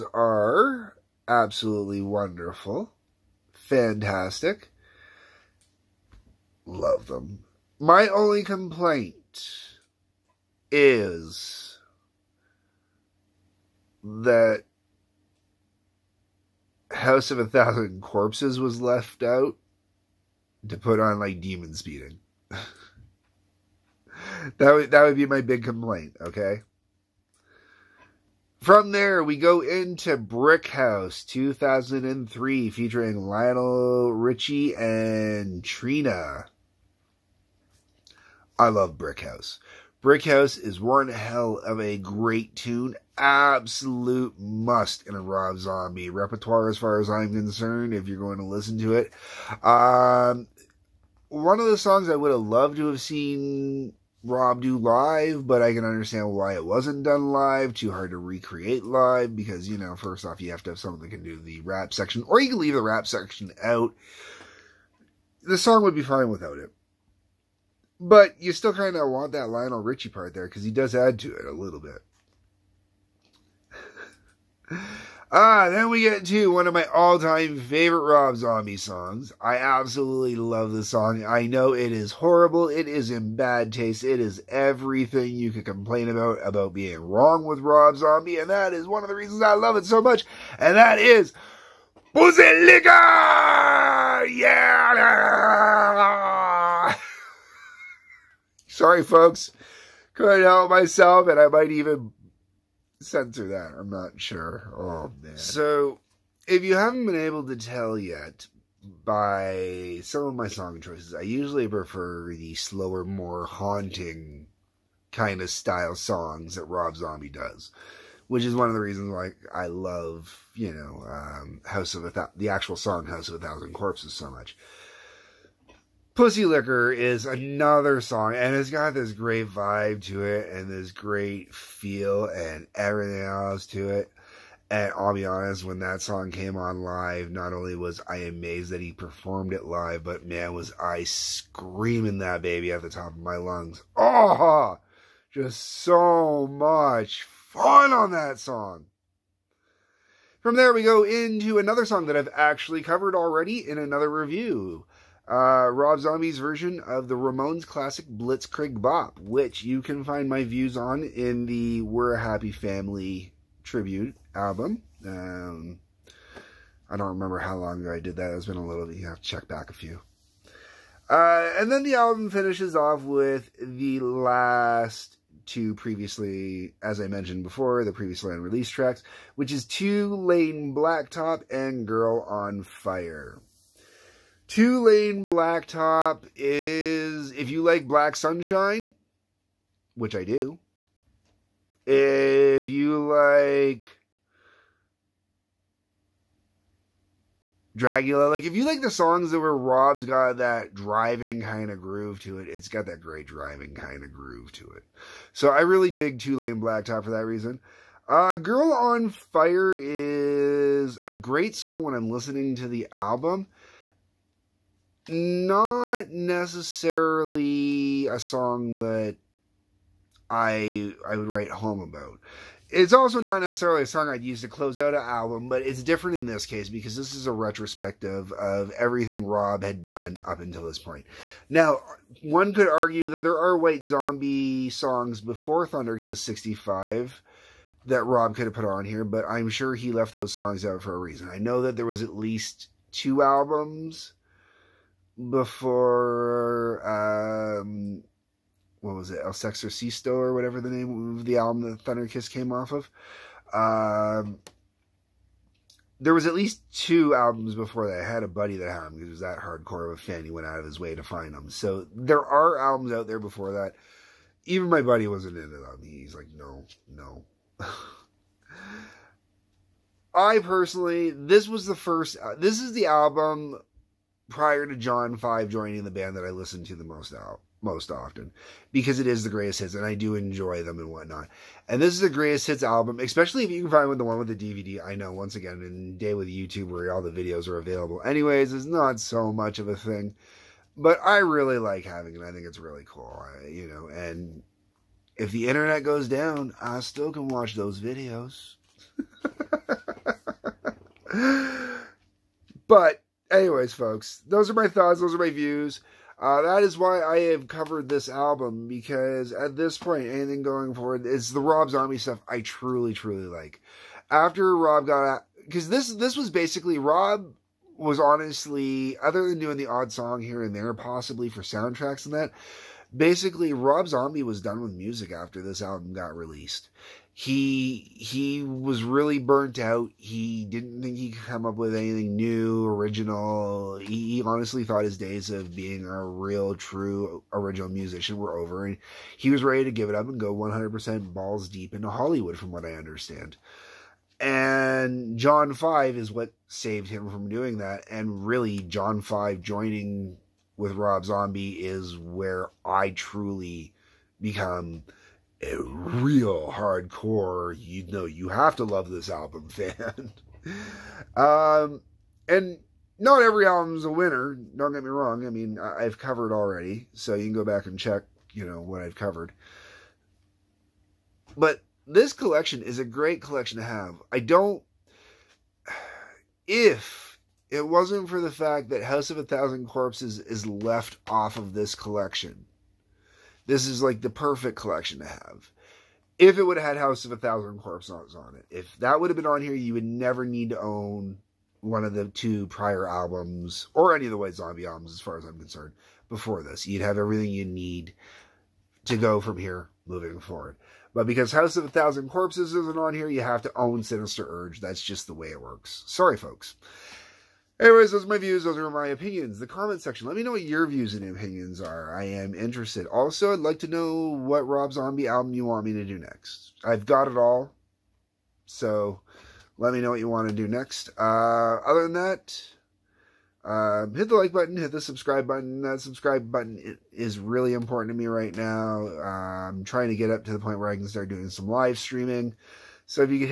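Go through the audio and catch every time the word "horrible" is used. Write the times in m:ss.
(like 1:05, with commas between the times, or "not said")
1:22.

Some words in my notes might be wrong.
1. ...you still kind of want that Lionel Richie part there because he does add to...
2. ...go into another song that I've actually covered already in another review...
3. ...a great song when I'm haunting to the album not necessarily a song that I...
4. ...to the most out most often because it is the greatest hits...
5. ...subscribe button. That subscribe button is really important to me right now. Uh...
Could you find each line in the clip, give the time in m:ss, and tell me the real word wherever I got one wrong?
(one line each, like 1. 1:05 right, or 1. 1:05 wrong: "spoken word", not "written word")
1. 1:08 right
2. 2:30 right
3. 3:31 wrong: "listening", not "haunting"
4. 4:36 right
5. 7:04 right.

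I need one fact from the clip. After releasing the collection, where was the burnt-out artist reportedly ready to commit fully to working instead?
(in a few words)
Hollywood.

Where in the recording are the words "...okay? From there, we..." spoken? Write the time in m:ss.
0:26.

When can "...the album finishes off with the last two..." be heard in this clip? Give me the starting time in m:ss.
2:51.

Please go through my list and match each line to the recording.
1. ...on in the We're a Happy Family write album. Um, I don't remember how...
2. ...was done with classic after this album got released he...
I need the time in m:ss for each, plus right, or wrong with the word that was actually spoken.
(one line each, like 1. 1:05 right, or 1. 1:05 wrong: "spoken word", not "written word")
1. 2:40 wrong: "tribute", not "write"
2. 5:24 wrong: "music", not "classic".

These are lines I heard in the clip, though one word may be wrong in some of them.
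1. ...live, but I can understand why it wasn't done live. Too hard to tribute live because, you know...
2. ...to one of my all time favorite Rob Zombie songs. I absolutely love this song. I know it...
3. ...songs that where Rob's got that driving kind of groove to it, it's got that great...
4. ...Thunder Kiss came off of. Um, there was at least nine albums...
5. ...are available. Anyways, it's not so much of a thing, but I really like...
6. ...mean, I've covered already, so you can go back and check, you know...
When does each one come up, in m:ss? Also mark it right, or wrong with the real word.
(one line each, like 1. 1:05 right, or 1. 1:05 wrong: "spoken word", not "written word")
1. 0:54 wrong: "recreate", not "tribute"
2. 1:16 right
3. 3:18 right
4. 4:11 wrong: "two", not "nine"
5. 4:47 right
6. 6:05 right.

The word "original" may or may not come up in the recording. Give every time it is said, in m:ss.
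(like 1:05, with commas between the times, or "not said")
5:32, 5:37.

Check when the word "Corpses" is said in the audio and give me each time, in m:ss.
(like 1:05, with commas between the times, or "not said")
0:18, 2:03, 6:19, 6:27, 6:42.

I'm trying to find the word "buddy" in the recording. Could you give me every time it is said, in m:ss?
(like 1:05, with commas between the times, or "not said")
4:18, 4:24.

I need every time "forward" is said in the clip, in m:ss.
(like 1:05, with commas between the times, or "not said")
5:10, 6:40.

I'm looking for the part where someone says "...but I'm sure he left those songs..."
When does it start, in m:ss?
3:59.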